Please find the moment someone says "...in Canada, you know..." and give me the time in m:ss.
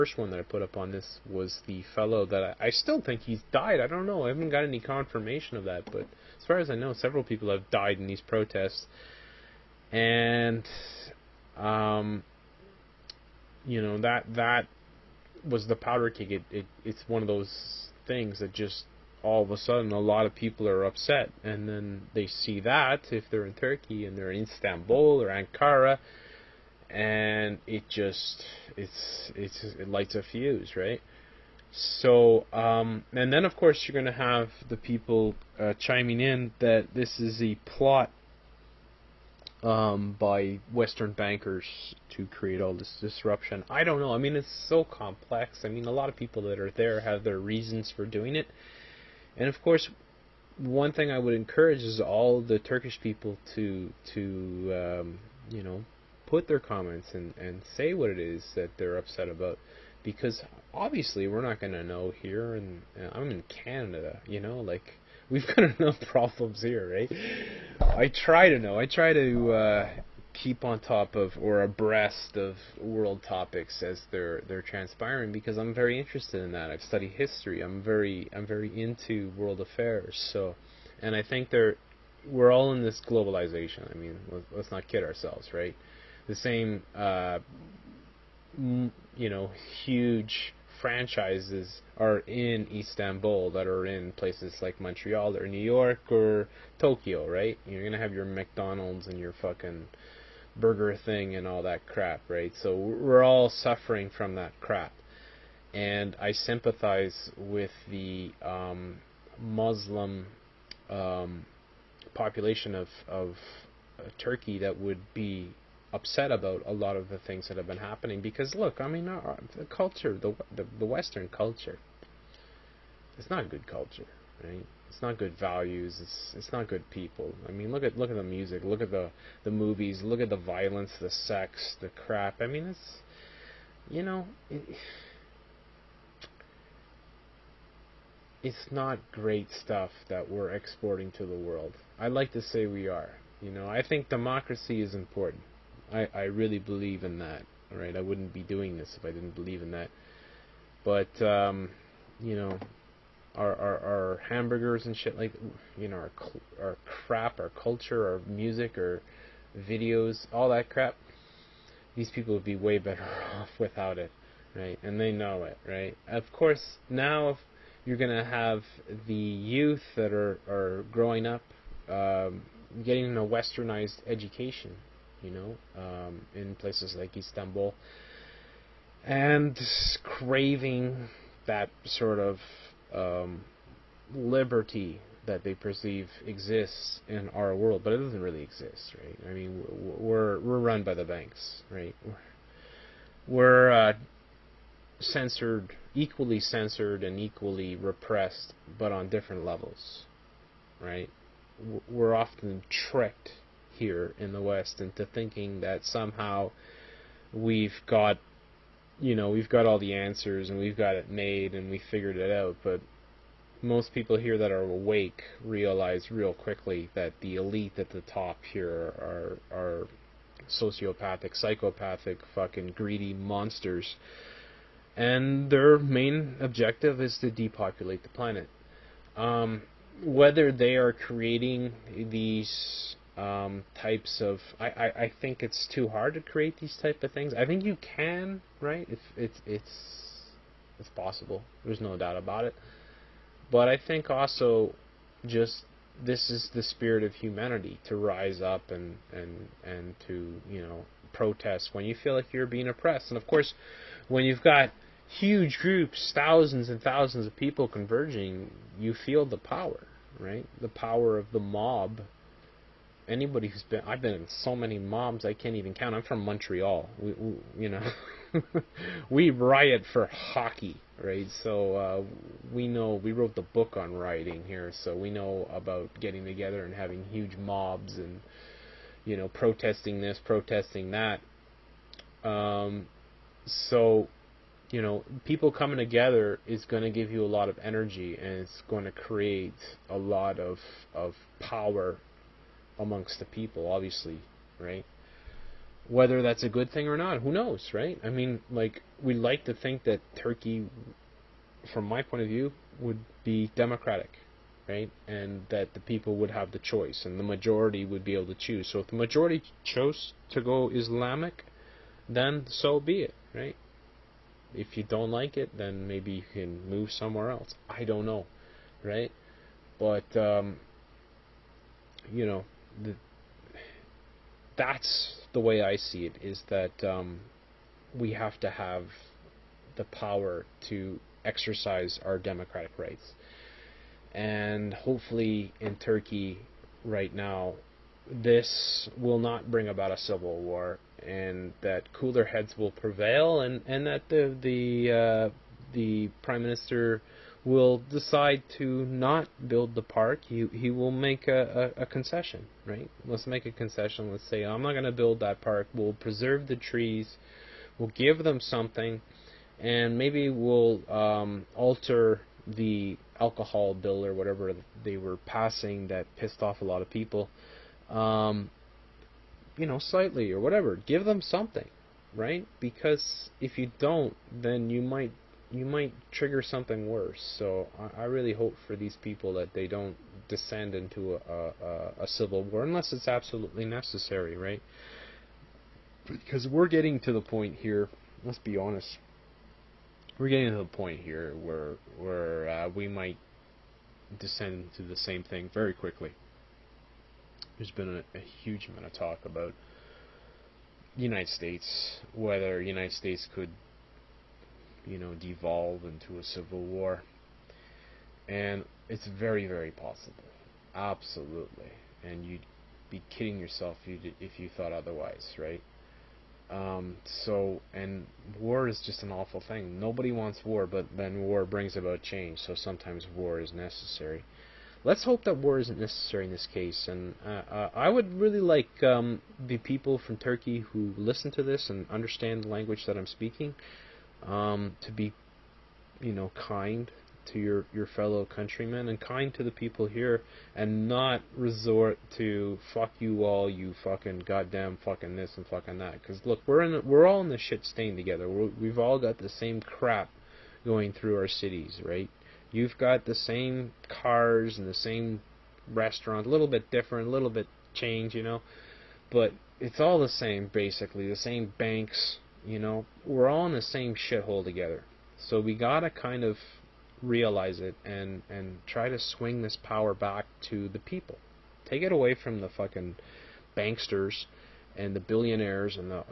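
1:03.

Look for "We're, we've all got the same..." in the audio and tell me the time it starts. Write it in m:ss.
7:28.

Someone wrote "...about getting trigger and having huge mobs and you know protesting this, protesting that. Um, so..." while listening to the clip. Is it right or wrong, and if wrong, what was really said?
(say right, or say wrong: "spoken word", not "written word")
wrong: "together", not "trigger".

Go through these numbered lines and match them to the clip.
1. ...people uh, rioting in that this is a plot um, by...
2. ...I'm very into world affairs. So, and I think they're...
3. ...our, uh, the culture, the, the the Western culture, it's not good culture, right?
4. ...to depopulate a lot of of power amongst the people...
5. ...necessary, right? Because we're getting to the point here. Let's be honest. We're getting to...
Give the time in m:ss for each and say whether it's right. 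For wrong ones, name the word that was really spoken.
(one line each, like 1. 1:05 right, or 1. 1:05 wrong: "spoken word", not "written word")
1. 0:34 wrong: "chiming", not "rioting"
2. 1:18 right
3. 1:59 right
4. 4:48 wrong: "create", not "depopulate"
5. 6:23 right.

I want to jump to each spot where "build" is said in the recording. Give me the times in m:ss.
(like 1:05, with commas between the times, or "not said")
5:49, 5:54.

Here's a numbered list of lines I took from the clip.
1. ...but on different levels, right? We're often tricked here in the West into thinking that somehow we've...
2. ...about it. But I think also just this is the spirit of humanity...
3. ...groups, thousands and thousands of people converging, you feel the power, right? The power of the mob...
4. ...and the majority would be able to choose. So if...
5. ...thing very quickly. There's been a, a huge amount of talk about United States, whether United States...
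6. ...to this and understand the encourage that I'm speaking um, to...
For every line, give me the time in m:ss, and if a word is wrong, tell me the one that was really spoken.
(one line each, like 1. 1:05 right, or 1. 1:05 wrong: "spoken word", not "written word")
1. 3:18 right
2. 4:02 right
3. 4:15 right
4. 5:07 right
5. 6:35 right
6. 7:11 wrong: "language", not "encourage".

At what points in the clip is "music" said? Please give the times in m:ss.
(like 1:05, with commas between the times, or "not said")
2:08, 2:38.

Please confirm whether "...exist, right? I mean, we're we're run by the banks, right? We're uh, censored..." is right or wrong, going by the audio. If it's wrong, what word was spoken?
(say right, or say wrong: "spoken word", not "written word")
right.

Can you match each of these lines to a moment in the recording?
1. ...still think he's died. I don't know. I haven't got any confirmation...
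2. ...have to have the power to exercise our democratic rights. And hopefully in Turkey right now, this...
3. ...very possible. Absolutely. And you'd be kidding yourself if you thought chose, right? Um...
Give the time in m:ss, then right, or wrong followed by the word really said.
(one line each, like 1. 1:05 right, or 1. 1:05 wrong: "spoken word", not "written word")
1. 0:02 right
2. 5:28 right
3. 6:49 wrong: "otherwise", not "chose".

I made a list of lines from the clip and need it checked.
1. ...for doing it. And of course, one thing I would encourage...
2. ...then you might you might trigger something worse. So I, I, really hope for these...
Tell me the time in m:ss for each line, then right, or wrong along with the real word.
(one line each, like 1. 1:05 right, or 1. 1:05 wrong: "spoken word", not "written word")
1. 0:47 right
2. 6:14 right.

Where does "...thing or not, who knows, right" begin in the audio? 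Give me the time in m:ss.
4:56.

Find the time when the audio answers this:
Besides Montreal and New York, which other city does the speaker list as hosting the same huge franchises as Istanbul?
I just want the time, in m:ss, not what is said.
1:36.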